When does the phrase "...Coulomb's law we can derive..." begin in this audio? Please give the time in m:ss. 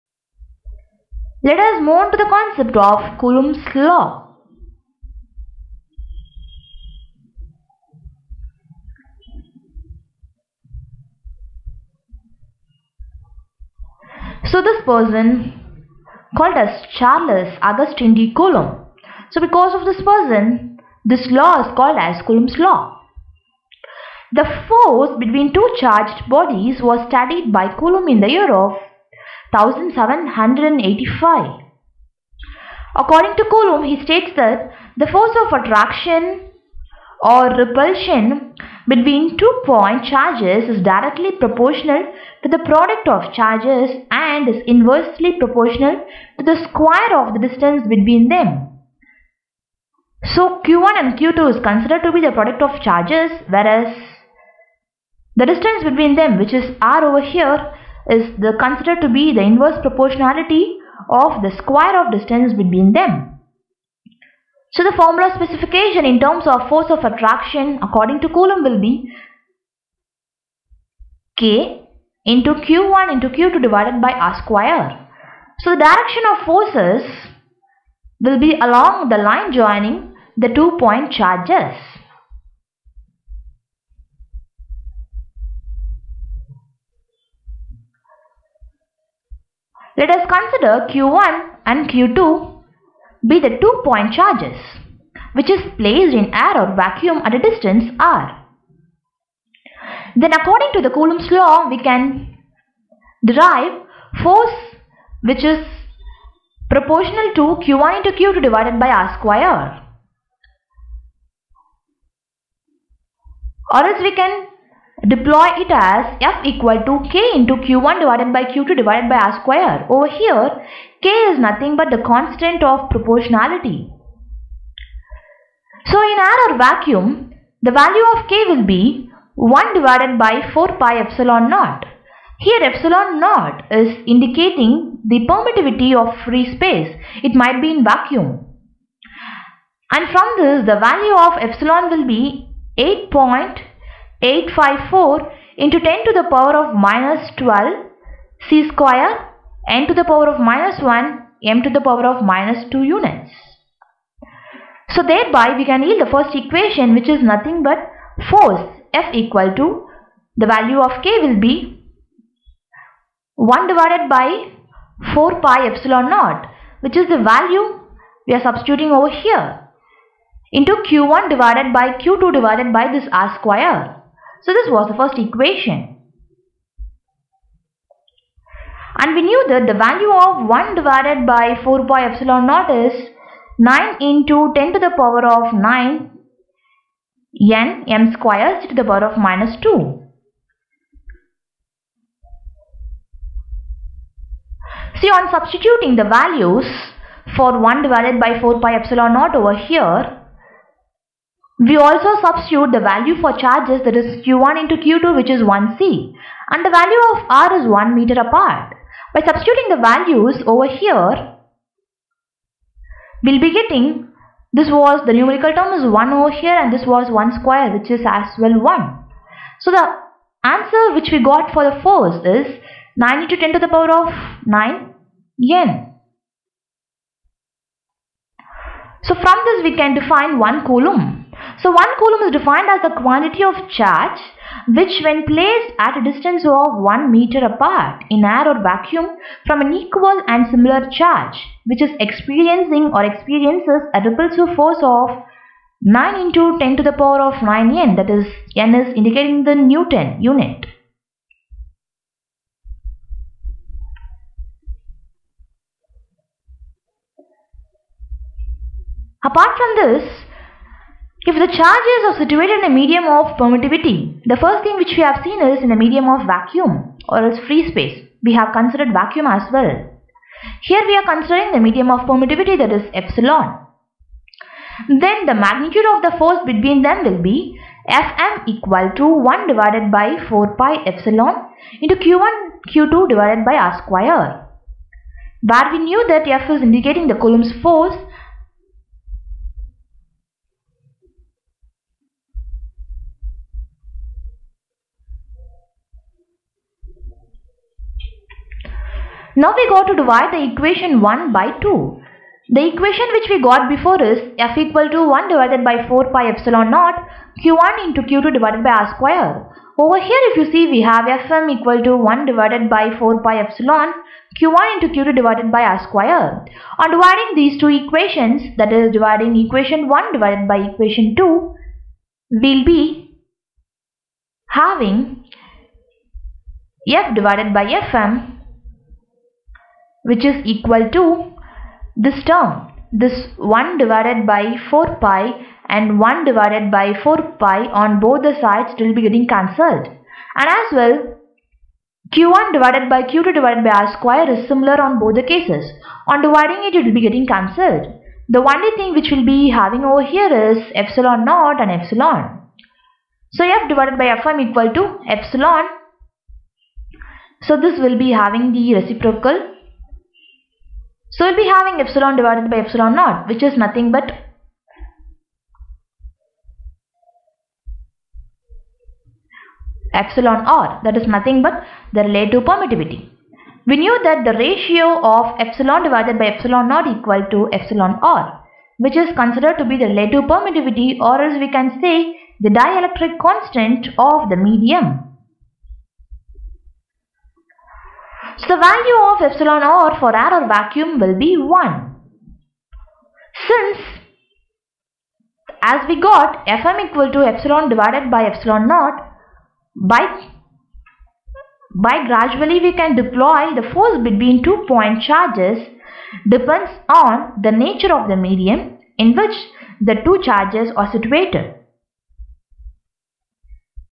1:40.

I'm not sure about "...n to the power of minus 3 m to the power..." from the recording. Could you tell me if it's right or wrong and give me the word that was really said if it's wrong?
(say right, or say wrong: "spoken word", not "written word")
wrong: "1", not "3".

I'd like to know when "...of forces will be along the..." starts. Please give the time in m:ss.
1:16.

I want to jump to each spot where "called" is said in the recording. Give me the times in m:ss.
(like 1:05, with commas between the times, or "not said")
0:16, 0:21.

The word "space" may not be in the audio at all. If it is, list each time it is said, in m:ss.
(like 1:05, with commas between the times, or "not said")
2:16, 4:27.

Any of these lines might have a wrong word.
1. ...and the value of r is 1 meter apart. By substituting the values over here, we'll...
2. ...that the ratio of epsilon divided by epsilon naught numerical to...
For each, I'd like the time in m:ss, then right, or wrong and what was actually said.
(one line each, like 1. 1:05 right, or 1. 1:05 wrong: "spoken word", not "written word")
1. 3:26 right
2. 6:14 wrong: "equal", not "numerical".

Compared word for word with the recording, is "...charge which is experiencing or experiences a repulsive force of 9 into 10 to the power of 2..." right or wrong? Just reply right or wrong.
wrong.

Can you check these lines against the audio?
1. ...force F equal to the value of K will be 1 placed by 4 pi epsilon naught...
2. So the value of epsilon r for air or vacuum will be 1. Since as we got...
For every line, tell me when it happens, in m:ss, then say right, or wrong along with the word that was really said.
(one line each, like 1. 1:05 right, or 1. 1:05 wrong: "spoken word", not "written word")
1. 2:38 wrong: "divided", not "placed"
2. 6:28 right.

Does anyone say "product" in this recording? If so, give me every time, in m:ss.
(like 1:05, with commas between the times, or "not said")
0:42, 0:52.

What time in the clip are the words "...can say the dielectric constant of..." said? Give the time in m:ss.
6:21.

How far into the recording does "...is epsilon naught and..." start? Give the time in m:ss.
5:50.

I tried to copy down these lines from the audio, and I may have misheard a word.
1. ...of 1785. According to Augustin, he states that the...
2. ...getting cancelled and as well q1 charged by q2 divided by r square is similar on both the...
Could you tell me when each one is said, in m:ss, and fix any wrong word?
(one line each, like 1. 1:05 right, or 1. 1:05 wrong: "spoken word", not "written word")
1. 0:28 wrong: "Coulomb", not "Augustin"
2. 5:39 wrong: "divided", not "charged".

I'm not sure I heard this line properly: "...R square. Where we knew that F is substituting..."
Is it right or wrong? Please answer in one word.
wrong.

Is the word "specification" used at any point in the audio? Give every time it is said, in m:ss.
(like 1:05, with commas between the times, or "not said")
1:05.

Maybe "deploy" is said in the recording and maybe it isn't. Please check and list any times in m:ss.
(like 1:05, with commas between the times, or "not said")
1:55, 6:42.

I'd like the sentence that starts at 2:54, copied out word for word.
So this was the first equation.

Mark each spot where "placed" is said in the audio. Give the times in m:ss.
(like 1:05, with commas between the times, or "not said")
1:35, 3:55.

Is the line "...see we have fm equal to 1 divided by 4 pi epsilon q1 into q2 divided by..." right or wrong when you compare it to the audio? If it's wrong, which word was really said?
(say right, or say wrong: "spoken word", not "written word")
right.